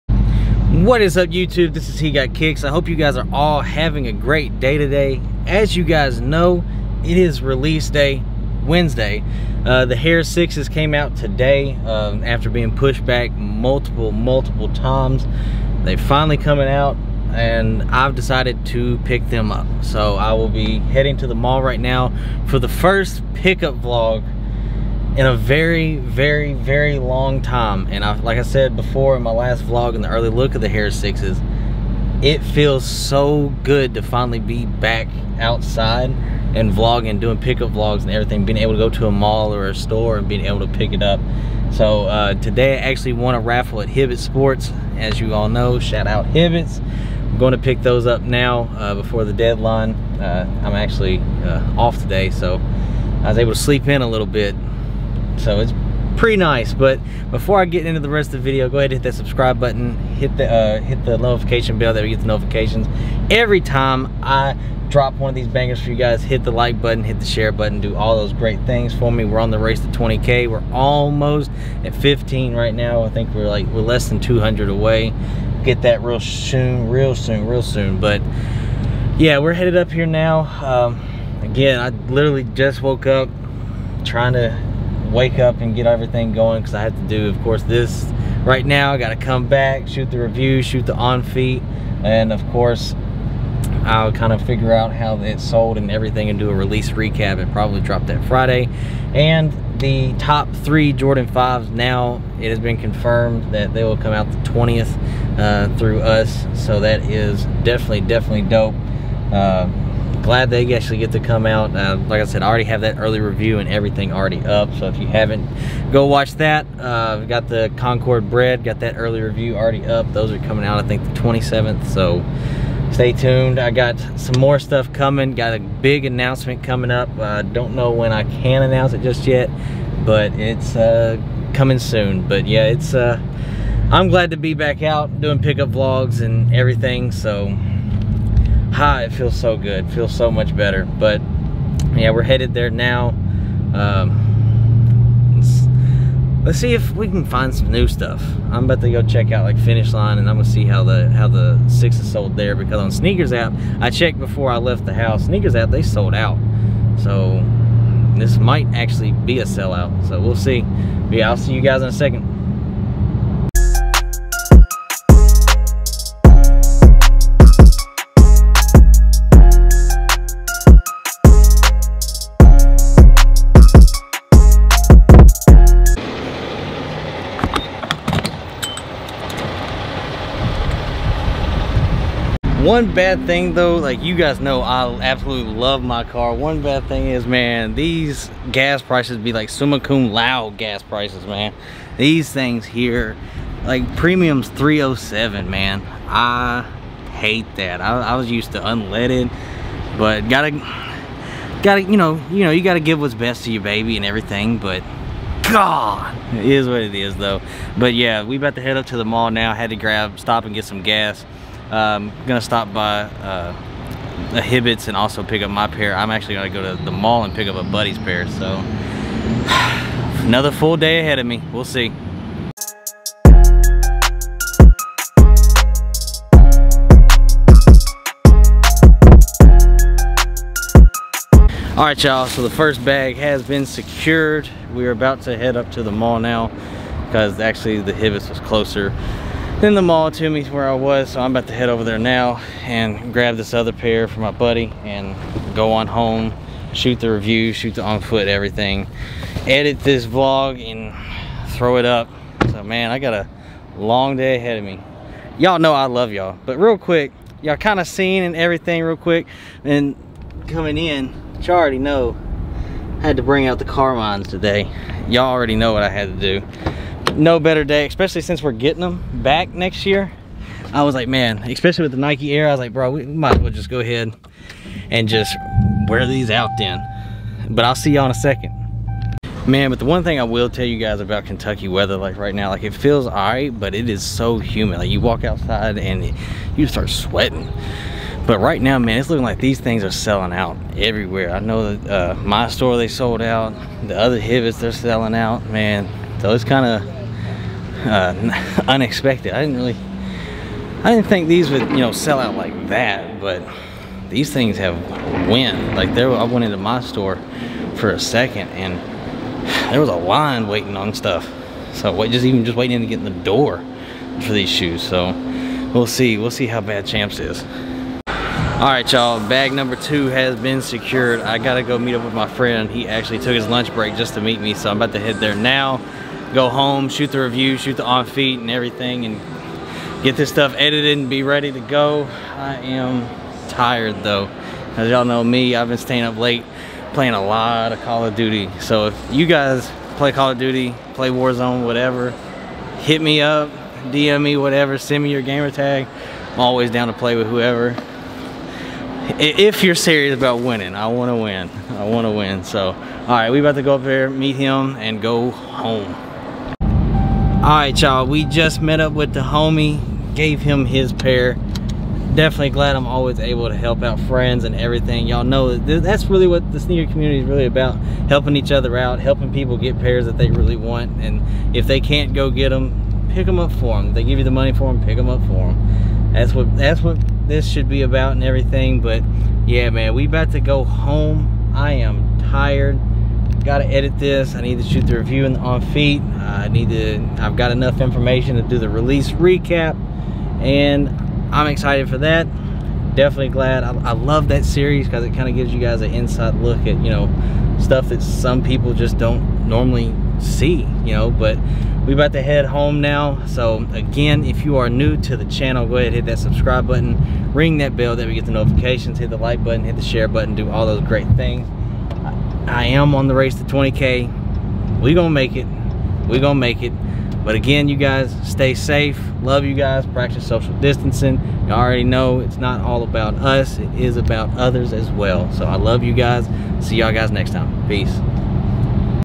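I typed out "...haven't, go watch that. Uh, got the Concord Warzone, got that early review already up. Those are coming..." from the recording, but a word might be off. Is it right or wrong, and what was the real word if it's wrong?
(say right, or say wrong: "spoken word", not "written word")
wrong: "Bred", not "Warzone".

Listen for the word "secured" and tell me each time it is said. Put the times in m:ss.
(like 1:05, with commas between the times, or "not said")
3:53, 5:20.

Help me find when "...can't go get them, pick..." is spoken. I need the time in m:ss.
6:11.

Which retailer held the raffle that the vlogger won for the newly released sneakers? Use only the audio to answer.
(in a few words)
Hibbett Sports.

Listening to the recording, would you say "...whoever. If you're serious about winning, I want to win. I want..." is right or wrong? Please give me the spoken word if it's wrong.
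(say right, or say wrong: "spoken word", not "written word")
right.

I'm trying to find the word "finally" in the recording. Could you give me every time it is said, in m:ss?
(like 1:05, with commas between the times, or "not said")
0:15, 0:34.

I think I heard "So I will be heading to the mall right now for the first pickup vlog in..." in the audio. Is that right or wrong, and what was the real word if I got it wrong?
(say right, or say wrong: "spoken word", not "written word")
right.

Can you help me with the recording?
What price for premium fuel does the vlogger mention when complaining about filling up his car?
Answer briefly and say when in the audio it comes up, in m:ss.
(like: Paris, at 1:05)
307, at 3:14.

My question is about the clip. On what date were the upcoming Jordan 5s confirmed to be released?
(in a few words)
the 20th.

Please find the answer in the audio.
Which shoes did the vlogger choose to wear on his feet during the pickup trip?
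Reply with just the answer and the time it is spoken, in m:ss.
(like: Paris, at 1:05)
Carmines, at 4:23.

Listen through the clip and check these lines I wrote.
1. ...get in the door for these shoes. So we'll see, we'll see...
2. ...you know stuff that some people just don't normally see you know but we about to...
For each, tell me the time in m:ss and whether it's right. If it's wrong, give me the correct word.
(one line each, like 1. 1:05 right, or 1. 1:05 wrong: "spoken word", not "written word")
1. 5:12 right
2. 6:36 right.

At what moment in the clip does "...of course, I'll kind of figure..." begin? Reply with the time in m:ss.
1:32.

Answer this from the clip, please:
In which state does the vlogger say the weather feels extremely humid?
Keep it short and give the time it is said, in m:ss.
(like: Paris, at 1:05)
Kentucky, at 4:41.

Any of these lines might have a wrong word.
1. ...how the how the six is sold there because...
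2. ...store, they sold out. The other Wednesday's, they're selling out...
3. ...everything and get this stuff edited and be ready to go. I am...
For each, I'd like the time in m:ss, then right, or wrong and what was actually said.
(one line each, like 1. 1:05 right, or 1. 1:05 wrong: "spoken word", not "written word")
1. 2:30 right
2. 4:52 wrong: "Hibbett", not "Wednesday"
3. 5:28 right.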